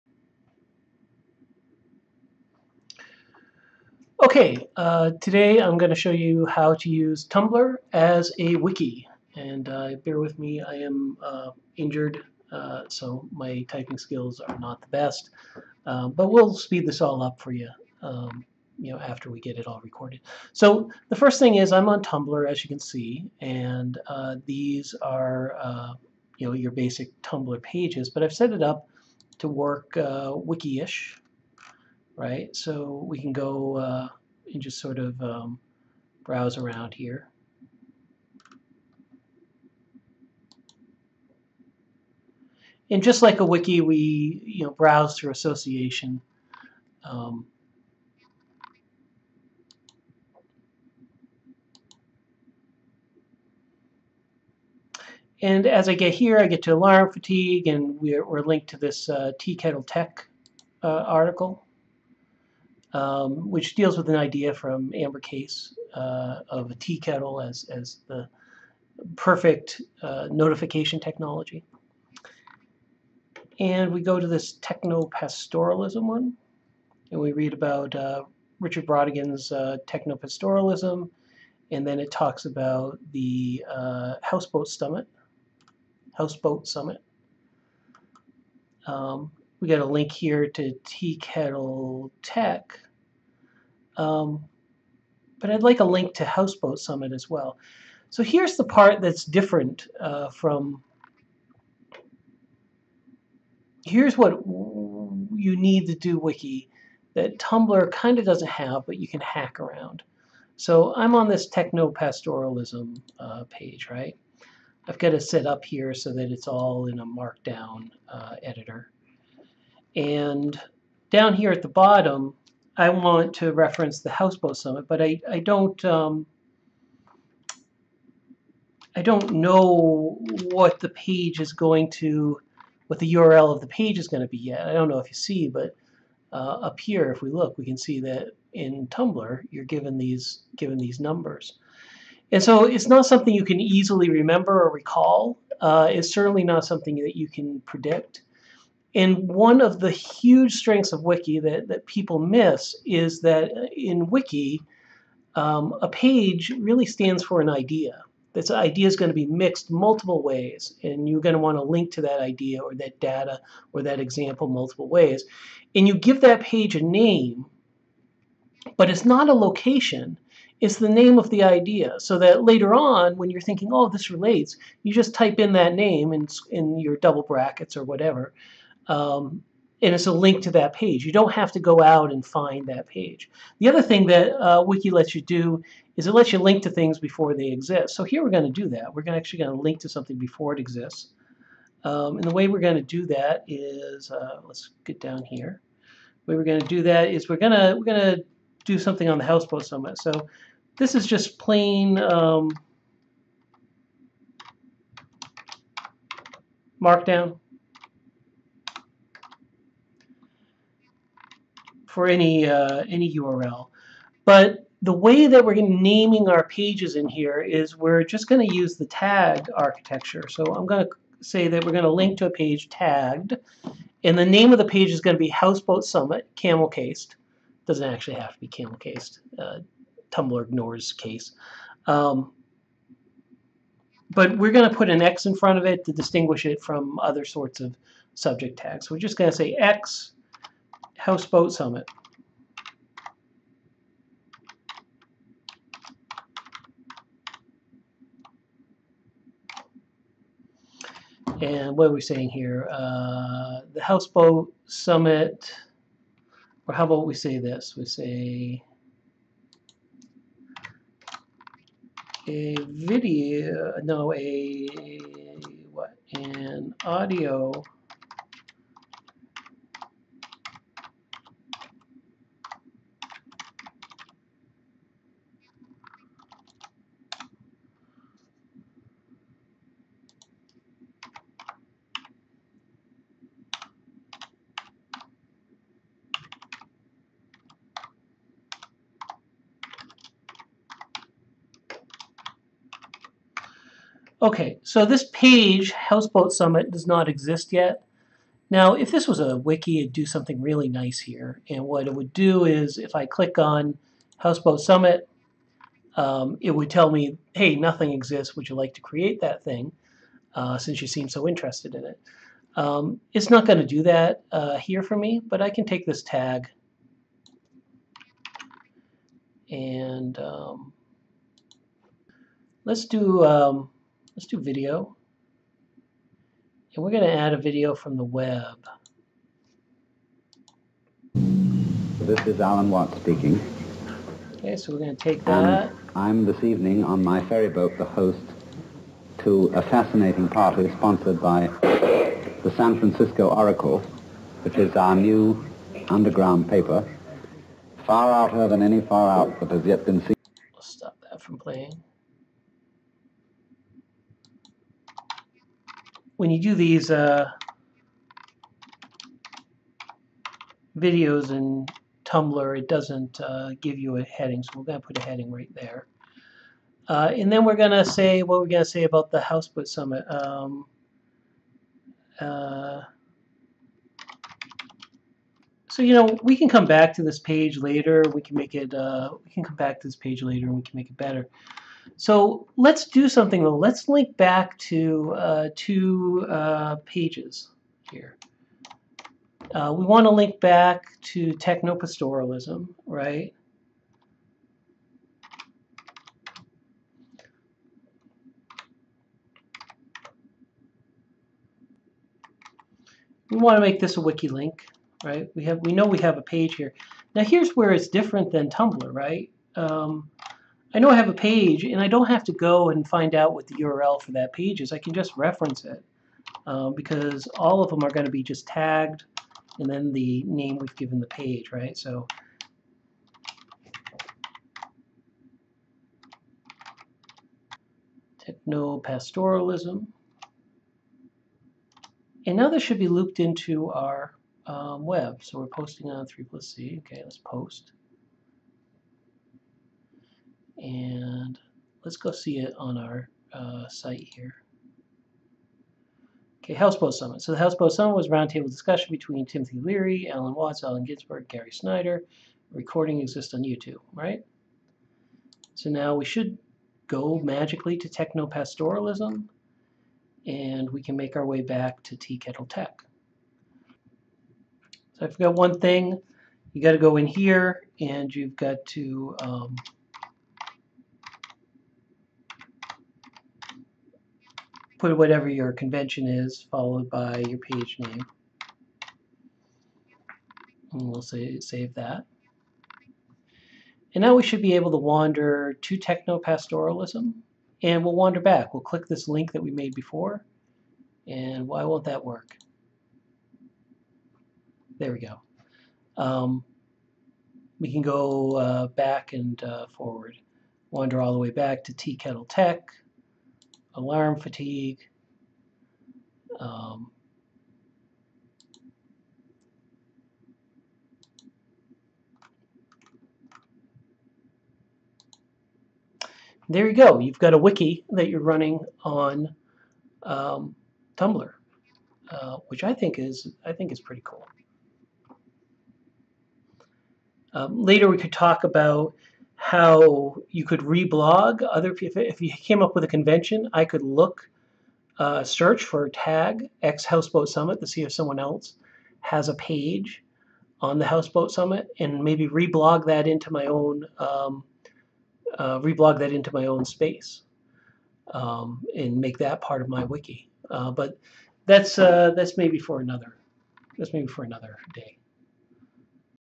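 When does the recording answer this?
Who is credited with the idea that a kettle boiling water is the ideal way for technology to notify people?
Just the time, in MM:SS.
01:04.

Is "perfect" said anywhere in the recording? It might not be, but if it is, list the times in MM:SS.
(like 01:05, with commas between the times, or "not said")
01:09.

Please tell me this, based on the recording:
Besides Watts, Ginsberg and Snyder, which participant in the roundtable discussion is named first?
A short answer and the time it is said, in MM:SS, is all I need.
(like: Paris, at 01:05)
Timothy Leary, at 07:29.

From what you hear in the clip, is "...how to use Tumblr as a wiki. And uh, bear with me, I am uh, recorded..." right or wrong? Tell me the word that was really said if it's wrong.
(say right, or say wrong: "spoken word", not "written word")
wrong: "injured", not "recorded".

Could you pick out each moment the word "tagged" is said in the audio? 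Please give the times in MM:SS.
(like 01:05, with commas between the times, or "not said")
03:42, 06:58.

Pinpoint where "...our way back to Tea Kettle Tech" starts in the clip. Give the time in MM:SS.
07:41.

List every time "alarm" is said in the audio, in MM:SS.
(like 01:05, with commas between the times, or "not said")
00:56, 08:23.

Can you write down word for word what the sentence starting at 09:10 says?
Uh, but that's uh, that's maybe for another that's maybe for another day.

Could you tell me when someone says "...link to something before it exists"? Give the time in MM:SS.
03:09.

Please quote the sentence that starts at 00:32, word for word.
So we can go uh, and just sort of um, browse around here.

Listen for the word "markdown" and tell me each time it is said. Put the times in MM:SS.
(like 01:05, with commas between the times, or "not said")
01:57, 03:26.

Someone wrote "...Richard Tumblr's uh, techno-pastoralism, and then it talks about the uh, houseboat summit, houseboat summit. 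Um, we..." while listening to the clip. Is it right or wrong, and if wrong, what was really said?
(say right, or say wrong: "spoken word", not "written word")
wrong: "Brautigan", not "Tumblr".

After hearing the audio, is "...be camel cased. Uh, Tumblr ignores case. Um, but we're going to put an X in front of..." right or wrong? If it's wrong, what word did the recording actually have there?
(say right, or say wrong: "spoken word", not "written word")
right.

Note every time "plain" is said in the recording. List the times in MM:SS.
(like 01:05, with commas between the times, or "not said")
03:21.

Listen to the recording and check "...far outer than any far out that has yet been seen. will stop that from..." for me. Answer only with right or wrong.
right.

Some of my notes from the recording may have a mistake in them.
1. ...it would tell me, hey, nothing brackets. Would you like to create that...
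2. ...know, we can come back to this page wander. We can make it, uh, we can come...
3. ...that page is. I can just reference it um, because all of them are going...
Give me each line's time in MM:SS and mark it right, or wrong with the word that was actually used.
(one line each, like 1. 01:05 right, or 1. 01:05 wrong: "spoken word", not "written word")
1. 05:06 wrong: "exists", not "brackets"
2. 06:15 wrong: "later", not "wander"
3. 06:54 right.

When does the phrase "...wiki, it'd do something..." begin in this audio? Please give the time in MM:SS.
04:59.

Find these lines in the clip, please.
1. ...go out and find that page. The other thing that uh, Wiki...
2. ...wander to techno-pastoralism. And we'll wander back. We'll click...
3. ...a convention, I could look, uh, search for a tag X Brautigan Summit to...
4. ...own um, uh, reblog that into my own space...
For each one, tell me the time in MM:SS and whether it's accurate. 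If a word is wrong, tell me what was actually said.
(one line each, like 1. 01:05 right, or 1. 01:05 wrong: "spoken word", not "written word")
1. 03:01 right
2. 08:04 right
3. 08:52 wrong: "Houseboat", not "Brautigan"
4. 09:03 right.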